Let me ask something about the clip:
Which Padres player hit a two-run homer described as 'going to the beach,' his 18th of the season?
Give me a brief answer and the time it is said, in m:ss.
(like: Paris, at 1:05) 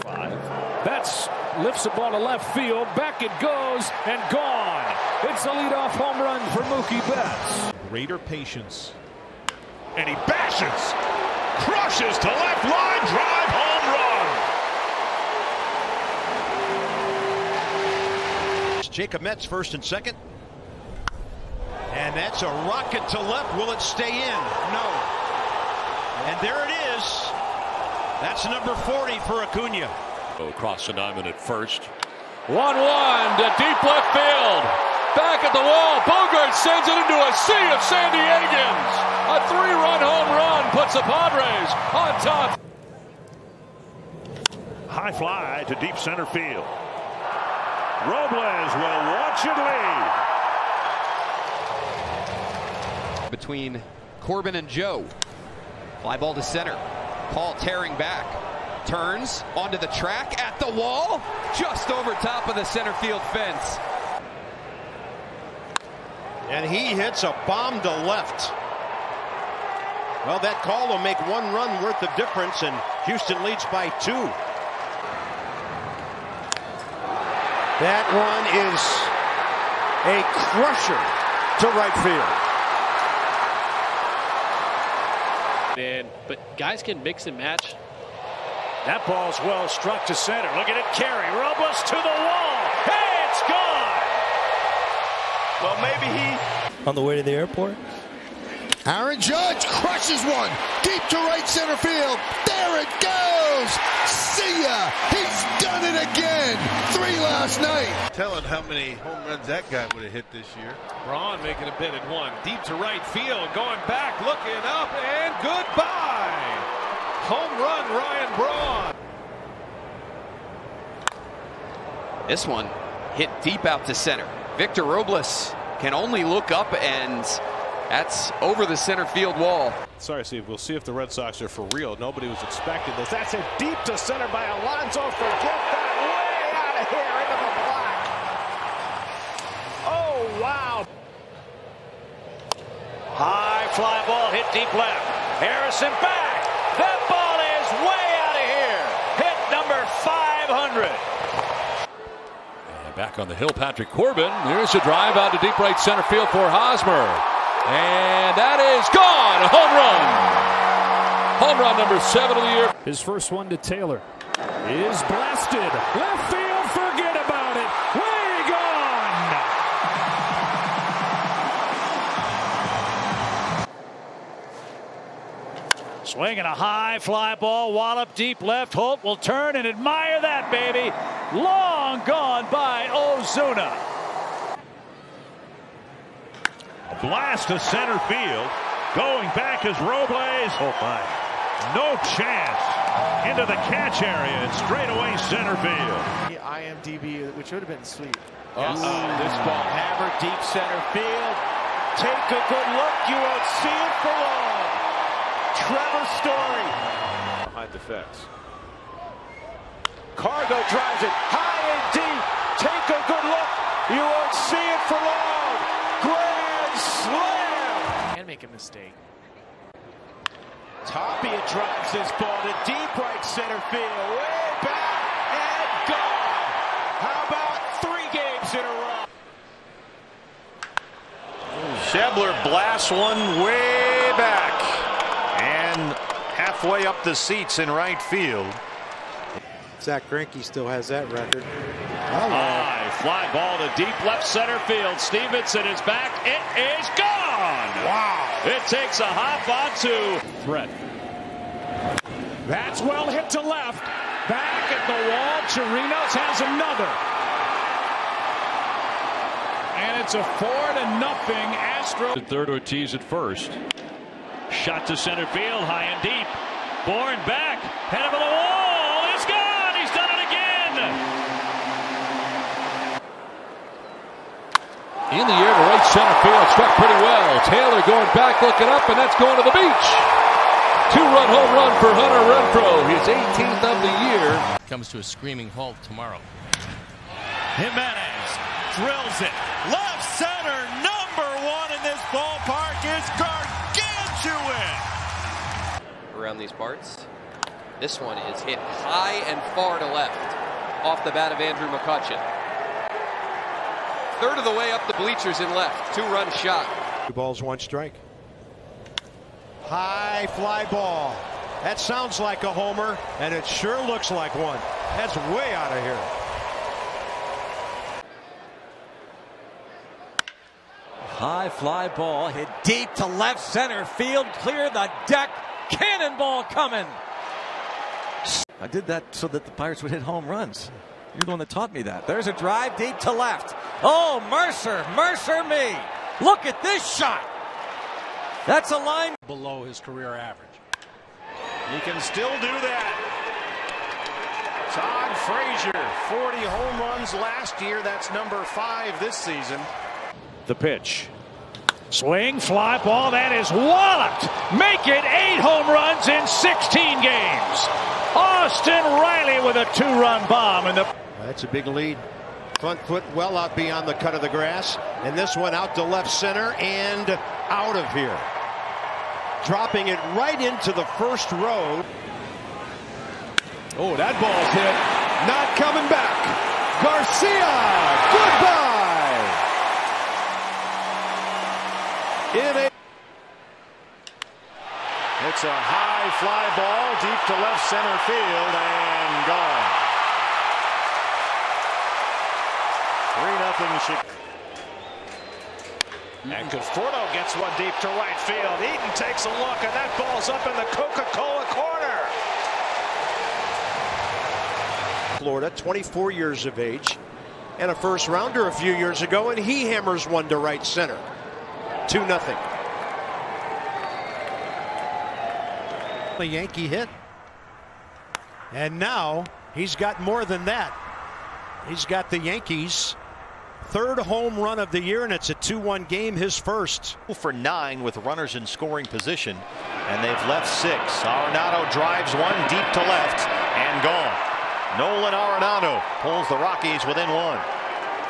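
Hunter Renfroe, at 4:41.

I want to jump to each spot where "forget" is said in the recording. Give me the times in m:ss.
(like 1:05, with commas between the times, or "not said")
2:15, 2:46.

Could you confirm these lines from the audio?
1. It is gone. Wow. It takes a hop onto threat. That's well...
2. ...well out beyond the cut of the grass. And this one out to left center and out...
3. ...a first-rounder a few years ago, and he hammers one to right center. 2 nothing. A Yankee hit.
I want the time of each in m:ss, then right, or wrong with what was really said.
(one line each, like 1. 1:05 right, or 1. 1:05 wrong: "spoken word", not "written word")
1. 4:06 right
2. 6:03 right
3. 6:47 right.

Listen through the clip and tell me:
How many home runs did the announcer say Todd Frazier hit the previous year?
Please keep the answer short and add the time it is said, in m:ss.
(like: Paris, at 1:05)
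40, at 5:46.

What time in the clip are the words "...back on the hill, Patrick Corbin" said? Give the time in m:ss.
2:32.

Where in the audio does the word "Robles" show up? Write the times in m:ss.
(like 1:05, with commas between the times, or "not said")
0:48, 2:04, 3:09.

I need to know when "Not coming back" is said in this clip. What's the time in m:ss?
6:15.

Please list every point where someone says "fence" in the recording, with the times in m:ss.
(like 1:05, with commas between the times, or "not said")
1:03, 3:27.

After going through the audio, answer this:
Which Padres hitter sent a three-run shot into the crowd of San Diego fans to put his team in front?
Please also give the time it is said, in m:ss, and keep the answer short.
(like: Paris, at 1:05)
Bogart, at 0:36.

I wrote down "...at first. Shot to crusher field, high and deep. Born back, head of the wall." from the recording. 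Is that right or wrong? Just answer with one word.
wrong.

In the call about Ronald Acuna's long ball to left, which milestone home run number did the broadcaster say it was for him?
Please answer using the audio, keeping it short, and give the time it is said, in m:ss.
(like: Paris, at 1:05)
40, at 0:28.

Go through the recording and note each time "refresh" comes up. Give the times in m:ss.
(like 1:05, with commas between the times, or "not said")
not said.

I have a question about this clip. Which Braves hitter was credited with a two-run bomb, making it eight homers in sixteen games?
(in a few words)
Austin Riley.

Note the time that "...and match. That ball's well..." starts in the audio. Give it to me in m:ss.
1:27.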